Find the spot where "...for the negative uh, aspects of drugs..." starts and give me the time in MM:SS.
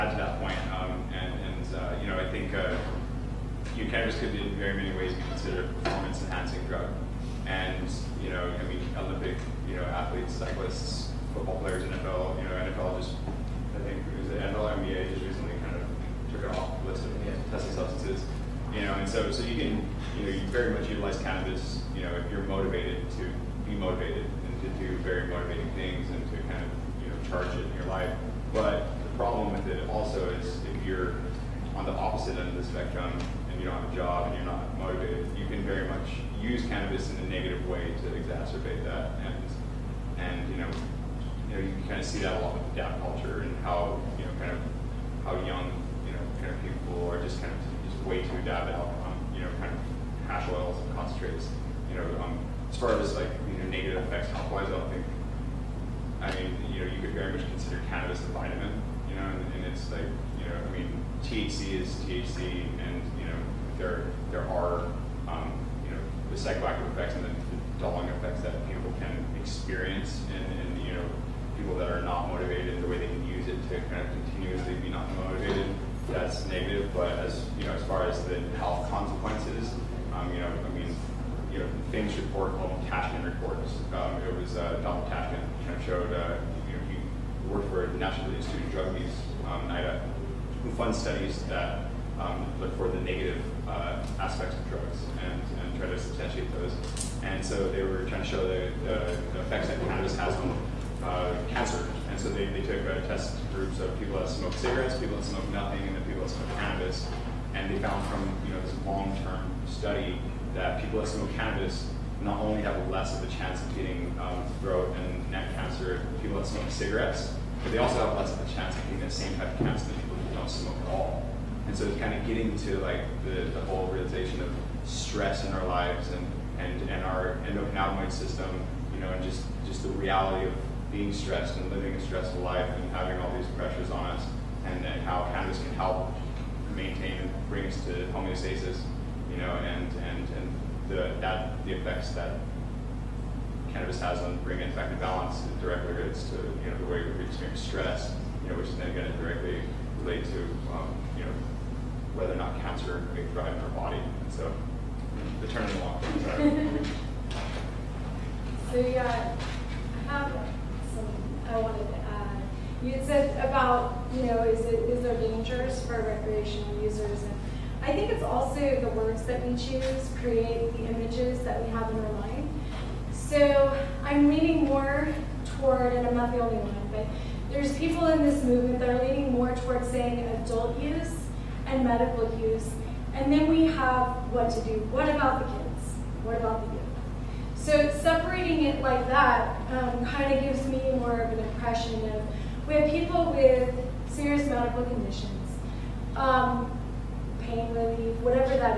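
01:32.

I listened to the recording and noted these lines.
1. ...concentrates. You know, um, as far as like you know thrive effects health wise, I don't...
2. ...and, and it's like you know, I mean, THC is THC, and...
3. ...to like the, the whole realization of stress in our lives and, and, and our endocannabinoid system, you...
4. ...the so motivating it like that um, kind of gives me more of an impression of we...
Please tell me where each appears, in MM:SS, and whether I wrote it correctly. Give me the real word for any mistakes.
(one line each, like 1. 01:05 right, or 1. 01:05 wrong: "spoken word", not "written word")
1. 00:50 wrong: "negative", not "thrive"
2. 00:59 right
3. 02:02 right
4. 03:06 wrong: "separating", not "motivating".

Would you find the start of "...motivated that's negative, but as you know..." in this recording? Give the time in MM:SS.
01:15.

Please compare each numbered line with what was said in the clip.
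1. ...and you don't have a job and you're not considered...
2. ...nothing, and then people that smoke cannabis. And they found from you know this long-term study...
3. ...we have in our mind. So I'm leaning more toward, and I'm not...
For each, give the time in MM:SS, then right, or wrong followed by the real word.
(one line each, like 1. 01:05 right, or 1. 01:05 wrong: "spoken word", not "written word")
1. 00:33 wrong: "motivated", not "considered"
2. 01:45 right
3. 02:51 right.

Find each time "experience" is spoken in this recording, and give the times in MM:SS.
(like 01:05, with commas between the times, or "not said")
01:09, 02:27.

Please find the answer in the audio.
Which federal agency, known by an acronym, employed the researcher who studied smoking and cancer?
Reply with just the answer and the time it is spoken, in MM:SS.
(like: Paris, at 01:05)
NIDA, at 01:29.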